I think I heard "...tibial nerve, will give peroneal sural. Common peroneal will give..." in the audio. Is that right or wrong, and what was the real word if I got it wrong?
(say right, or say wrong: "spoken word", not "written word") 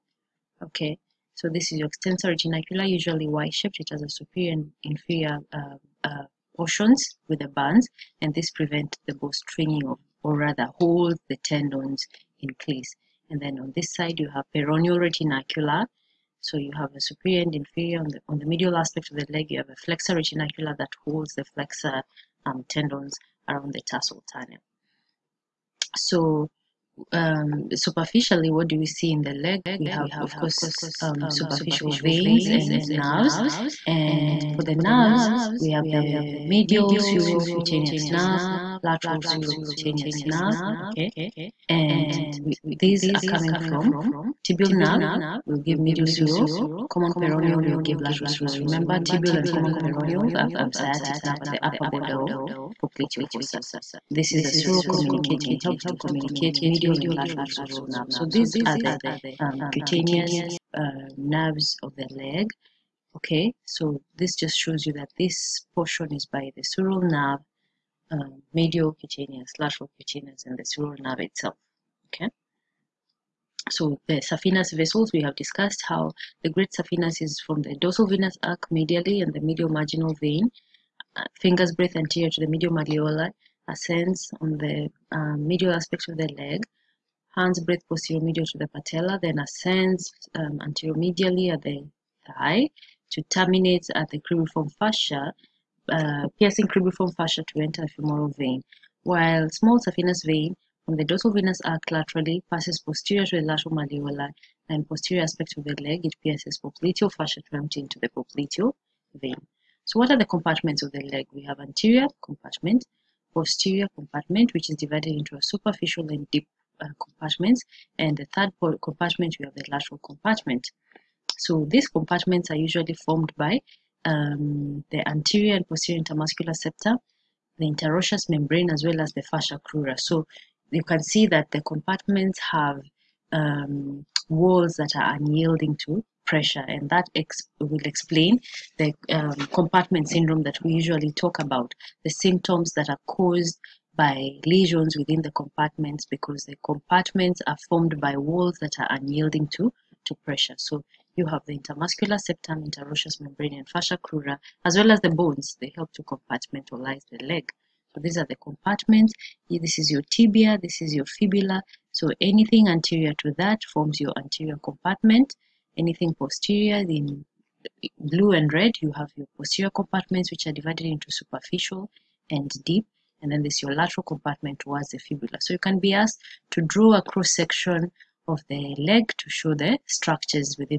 wrong: "medial", not "peroneal".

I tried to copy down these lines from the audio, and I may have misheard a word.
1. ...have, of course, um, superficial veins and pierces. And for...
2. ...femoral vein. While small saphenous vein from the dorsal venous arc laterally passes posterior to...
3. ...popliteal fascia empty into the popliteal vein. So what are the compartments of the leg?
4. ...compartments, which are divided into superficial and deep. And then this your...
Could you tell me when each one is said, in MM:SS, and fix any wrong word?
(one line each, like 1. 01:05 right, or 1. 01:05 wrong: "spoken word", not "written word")
1. 00:29 wrong: "nerves", not "pierces"
2. 01:37 right
3. 01:46 right
4. 02:49 right.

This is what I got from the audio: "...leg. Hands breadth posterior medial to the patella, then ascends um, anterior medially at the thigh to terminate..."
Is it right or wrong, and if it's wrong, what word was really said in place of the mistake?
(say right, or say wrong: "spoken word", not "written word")
right.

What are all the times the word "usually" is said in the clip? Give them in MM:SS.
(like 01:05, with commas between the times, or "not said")
00:02, 02:02, 02:20.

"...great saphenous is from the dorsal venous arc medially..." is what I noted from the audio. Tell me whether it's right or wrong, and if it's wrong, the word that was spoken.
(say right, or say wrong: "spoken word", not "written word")
right.